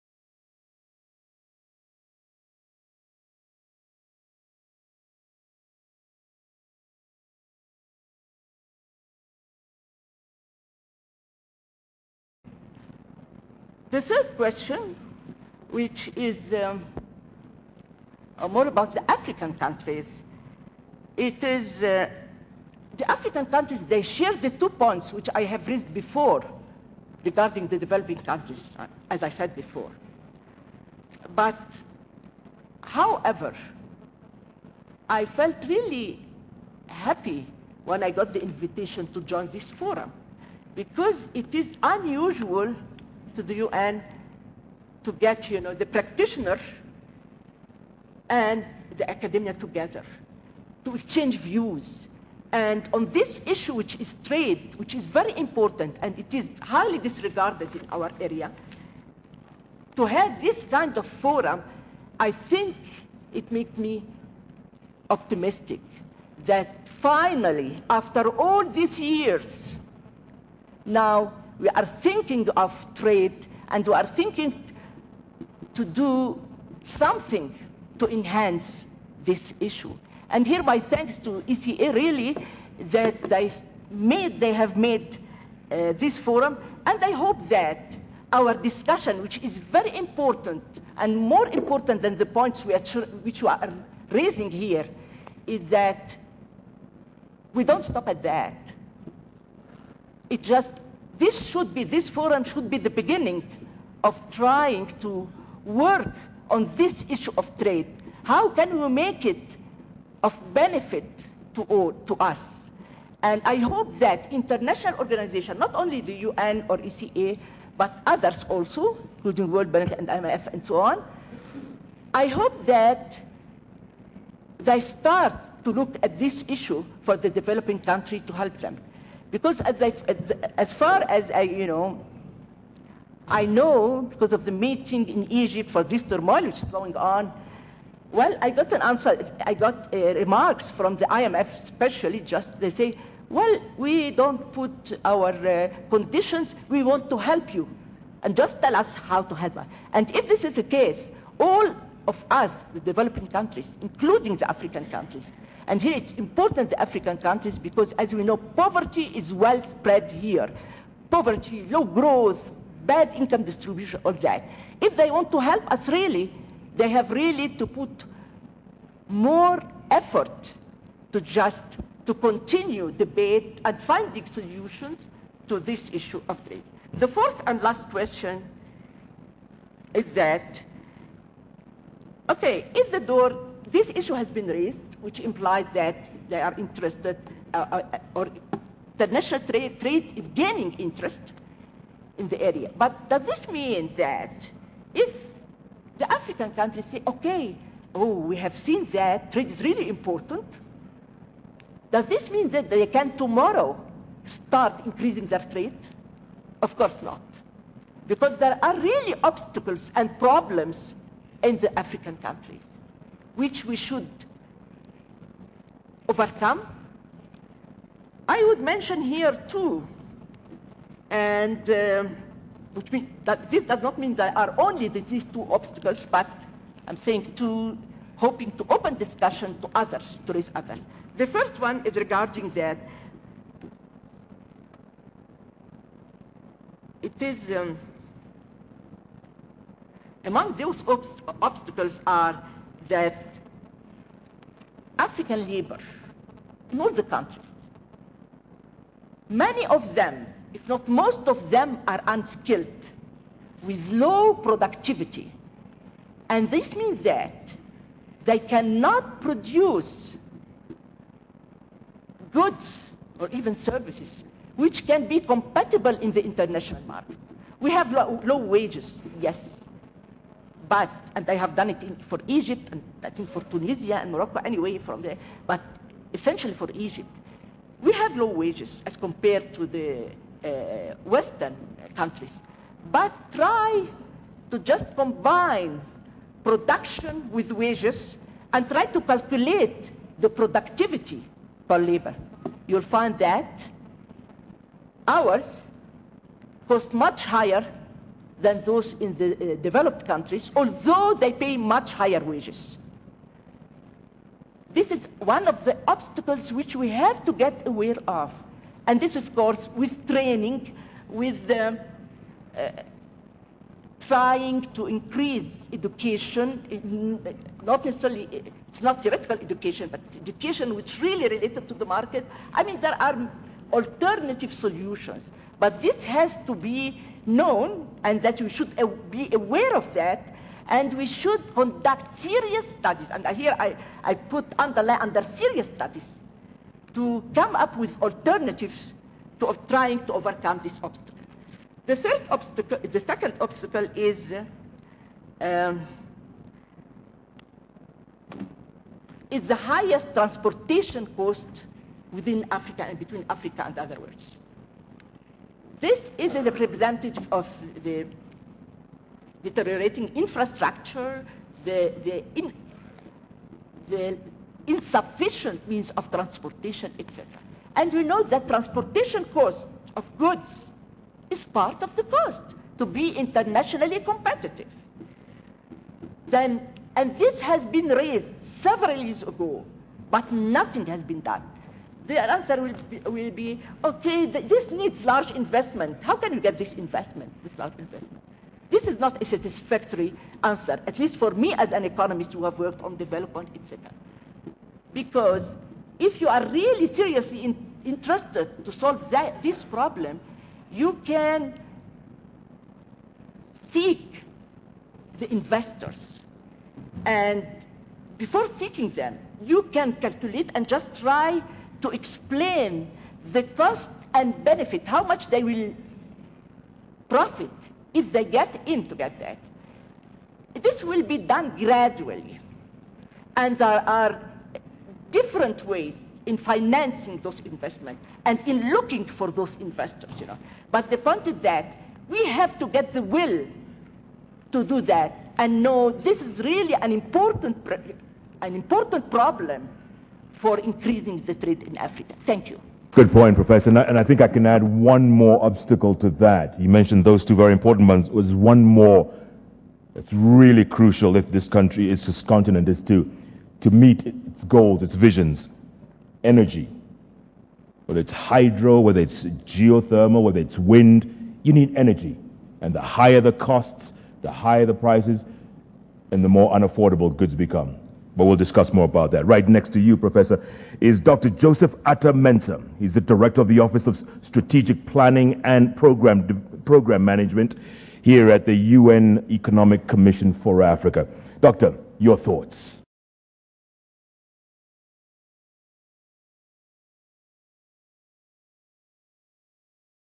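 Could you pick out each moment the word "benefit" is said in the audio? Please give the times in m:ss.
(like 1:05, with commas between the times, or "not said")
1:50, 6:54.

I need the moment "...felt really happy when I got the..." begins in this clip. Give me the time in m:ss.
0:35.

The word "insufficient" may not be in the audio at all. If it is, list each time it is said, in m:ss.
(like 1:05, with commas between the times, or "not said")
6:04.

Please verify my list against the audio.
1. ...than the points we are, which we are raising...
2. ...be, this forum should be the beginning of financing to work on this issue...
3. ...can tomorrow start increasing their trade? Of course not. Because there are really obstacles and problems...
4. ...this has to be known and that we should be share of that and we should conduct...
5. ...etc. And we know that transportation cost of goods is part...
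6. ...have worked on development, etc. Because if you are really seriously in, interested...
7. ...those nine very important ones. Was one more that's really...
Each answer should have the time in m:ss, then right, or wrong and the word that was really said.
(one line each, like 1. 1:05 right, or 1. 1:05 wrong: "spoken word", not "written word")
1. 1:32 right
2. 1:41 wrong: "trying", not "financing"
3. 3:22 right
4. 5:25 wrong: "aware", not "share"
5. 6:06 right
6. 6:32 right
7. 7:27 wrong: "two", not "nine".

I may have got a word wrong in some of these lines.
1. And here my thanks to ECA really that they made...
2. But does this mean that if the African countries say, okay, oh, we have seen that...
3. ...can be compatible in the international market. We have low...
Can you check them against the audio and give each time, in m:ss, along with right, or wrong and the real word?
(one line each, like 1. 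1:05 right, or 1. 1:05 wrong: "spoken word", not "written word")
1. 1:20 right
2. 3:12 right
3. 4:24 right.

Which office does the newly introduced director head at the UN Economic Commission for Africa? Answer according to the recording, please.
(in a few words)
Office of Strategic Planning.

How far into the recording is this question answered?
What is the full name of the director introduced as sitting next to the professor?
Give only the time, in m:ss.
7:51.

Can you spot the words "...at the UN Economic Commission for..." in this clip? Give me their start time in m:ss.
7:58.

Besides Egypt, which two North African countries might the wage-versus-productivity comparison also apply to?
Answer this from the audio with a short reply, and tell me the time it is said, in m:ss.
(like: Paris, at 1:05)
Tunisia and Morocco, at 4:33.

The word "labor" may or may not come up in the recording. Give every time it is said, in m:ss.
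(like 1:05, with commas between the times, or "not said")
4:05, 4:51.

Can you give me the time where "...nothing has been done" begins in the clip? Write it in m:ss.
6:20.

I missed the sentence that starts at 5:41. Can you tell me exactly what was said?
The third obstacle, the second obstacle is uh, um, is the highest transportation cost within Africa and between Africa and other worlds.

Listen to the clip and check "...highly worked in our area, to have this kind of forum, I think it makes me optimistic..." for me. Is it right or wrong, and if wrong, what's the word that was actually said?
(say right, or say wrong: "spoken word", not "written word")
wrong: "disregarded", not "worked".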